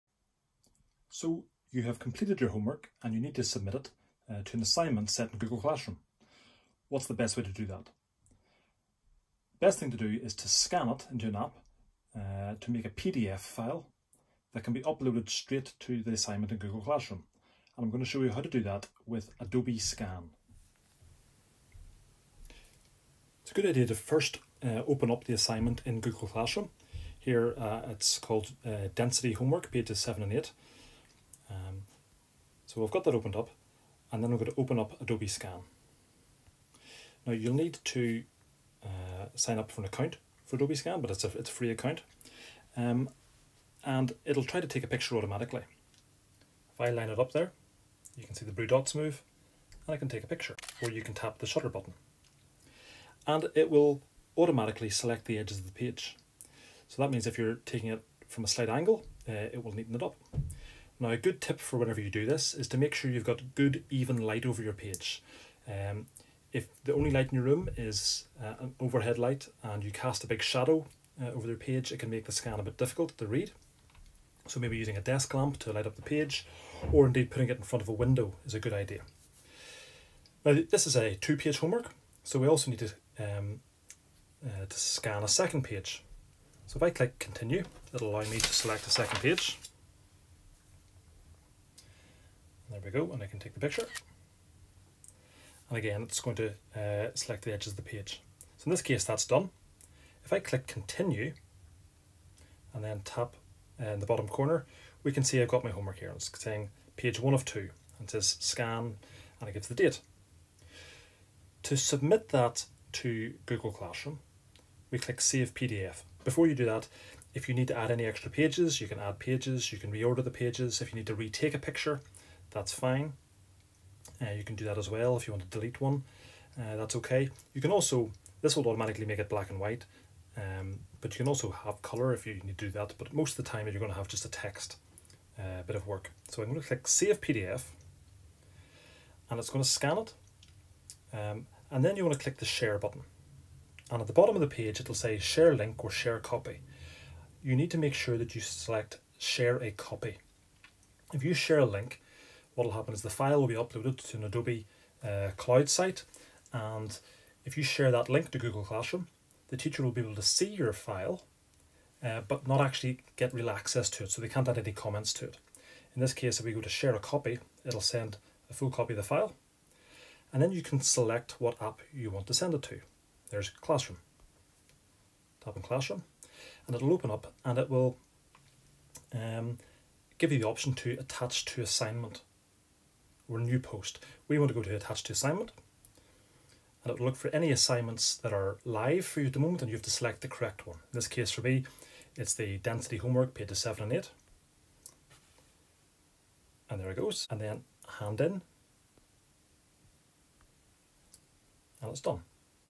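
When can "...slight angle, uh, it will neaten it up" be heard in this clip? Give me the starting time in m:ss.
0:58.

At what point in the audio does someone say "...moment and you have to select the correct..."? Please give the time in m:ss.
3:09.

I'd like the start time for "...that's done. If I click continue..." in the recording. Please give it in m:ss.
1:39.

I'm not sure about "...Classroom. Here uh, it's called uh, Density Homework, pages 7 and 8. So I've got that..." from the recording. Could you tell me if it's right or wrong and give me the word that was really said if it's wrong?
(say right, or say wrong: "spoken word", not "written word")
right.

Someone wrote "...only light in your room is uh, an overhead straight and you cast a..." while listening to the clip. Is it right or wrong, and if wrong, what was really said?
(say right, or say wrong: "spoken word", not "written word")
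wrong: "light", not "straight".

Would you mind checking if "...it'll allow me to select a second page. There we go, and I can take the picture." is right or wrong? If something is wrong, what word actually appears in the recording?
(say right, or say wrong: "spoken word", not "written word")
right.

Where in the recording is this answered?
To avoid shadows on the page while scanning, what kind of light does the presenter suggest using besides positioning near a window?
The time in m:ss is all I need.
1:15.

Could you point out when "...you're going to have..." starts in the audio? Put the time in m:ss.
2:13.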